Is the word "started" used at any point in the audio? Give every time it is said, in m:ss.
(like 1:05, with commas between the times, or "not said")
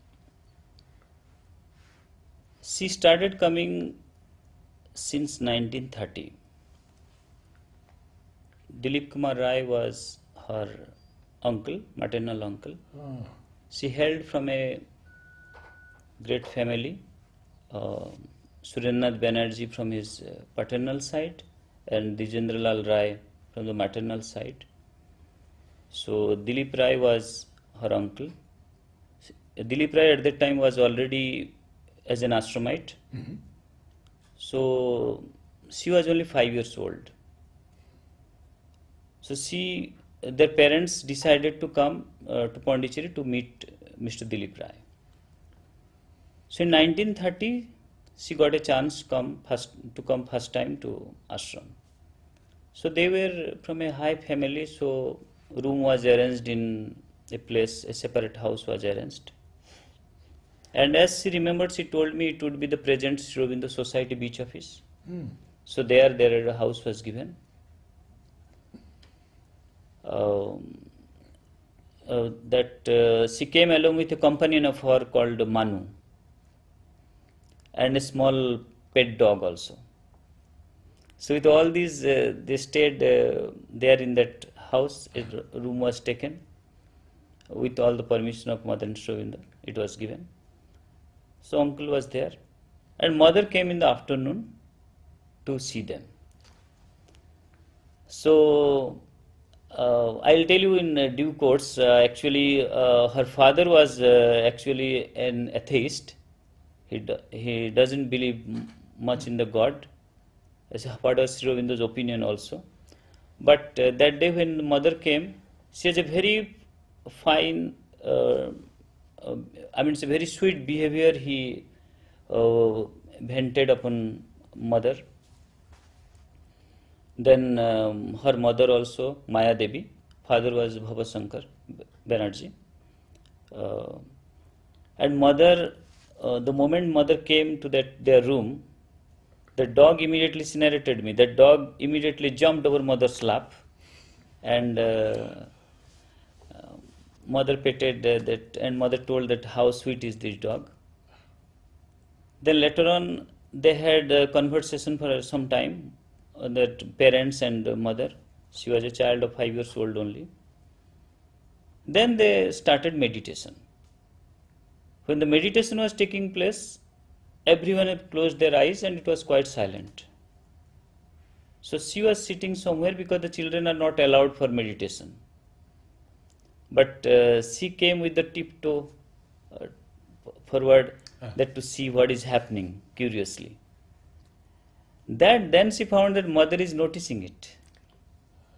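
0:02, 2:42.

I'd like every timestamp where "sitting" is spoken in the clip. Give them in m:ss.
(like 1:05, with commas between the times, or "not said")
2:52.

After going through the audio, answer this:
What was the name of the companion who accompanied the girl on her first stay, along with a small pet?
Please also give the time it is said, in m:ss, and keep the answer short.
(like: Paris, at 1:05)
Manu, at 1:15.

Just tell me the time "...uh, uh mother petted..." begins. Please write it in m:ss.
2:24.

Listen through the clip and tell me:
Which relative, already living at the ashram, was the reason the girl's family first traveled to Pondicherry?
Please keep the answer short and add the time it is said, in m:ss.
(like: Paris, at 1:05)
Dilip Kumar Roy, at 0:08.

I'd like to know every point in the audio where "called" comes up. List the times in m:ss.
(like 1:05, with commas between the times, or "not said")
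1:15.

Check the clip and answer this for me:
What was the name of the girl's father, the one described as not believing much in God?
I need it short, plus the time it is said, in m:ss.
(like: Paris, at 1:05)
Bhava Shankar Banerjee, at 2:10.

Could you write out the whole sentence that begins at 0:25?
So Dilip Roy was her uncle.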